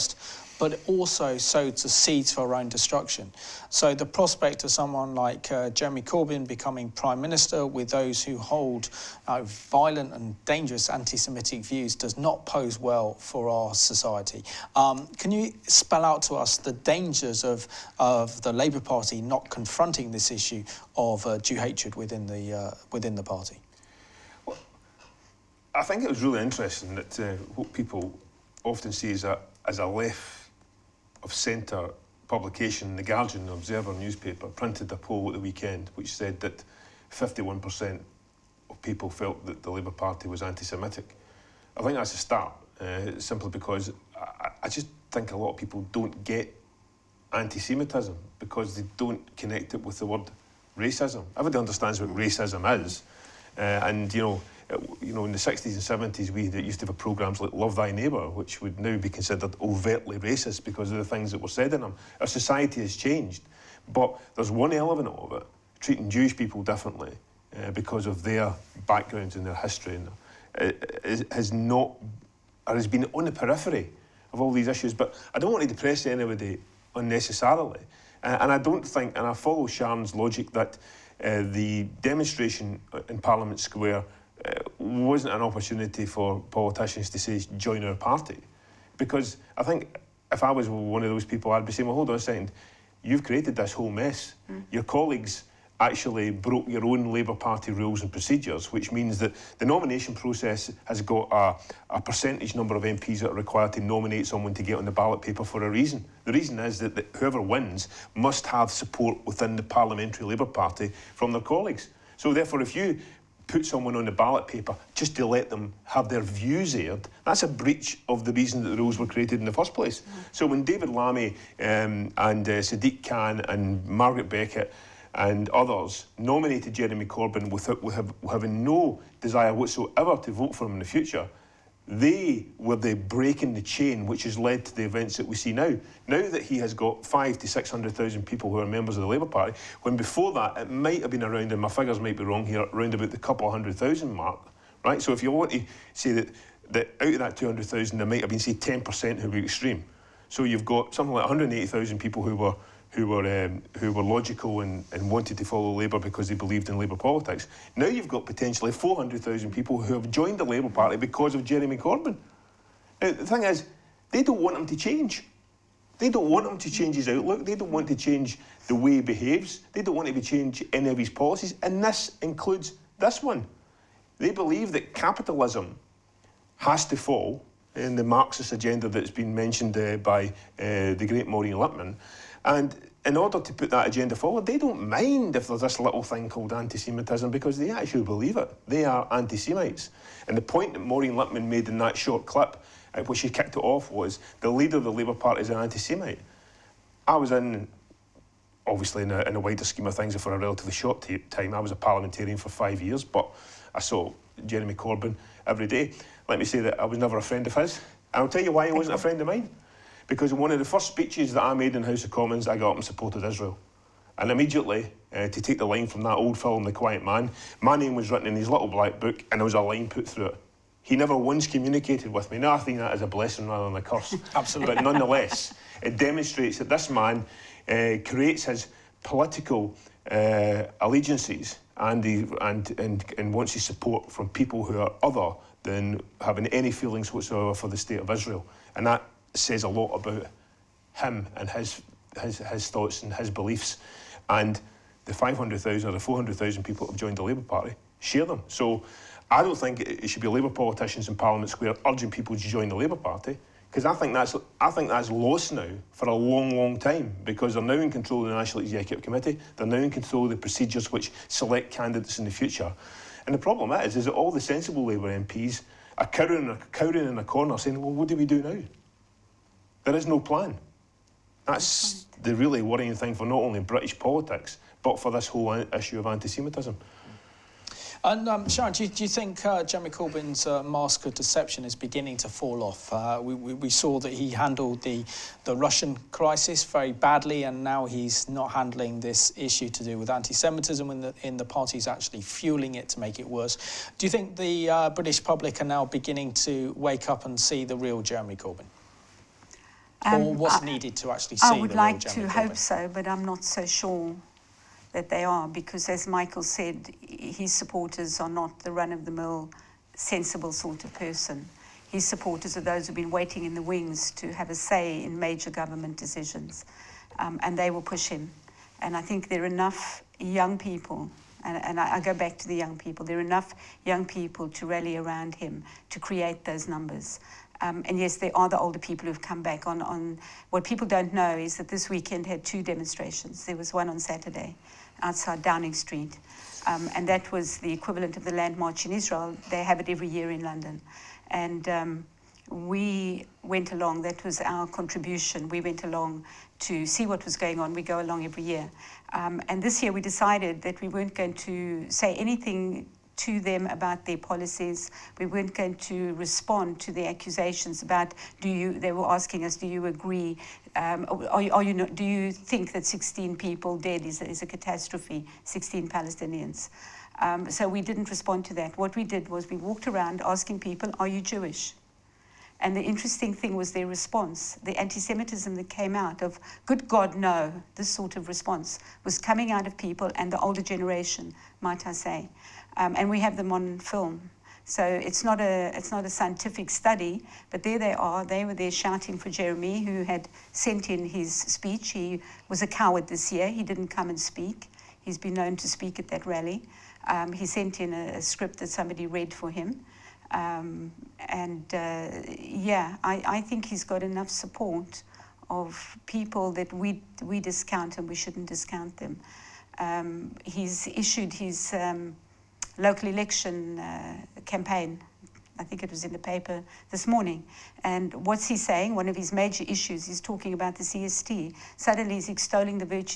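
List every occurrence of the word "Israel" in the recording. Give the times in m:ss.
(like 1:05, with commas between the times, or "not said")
3:33, 3:58, 5:38.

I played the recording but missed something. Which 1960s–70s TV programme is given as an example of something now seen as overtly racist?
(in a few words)
Love Thy Neighbour.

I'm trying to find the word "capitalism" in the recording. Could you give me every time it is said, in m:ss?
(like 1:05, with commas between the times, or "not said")
2:54.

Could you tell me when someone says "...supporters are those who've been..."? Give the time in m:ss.
5:12.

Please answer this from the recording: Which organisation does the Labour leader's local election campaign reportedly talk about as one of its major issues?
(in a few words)
CST.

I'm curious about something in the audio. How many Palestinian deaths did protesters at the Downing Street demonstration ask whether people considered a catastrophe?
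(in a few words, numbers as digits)
16.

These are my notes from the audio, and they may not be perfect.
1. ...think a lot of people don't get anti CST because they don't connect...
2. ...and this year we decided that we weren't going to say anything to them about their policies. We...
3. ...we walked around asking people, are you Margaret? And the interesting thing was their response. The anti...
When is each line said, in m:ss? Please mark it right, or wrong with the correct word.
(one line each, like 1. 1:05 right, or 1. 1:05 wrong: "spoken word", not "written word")
1. 0:45 wrong: "Semitism", not "CST"
2. 5:49 right
3. 6:09 wrong: "Jewish", not "Margaret".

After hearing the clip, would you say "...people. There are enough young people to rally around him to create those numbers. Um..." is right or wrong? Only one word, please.
right.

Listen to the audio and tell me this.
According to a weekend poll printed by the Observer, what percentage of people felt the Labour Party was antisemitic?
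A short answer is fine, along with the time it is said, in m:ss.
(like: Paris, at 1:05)
51%, at 0:37.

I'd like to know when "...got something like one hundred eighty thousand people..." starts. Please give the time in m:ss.
2:30.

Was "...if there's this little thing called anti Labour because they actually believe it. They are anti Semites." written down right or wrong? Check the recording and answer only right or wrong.
wrong.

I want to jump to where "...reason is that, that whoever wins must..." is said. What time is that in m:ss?
1:46.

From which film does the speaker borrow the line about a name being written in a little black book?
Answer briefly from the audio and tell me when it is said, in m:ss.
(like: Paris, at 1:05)
The Quiet Man, at 3:36.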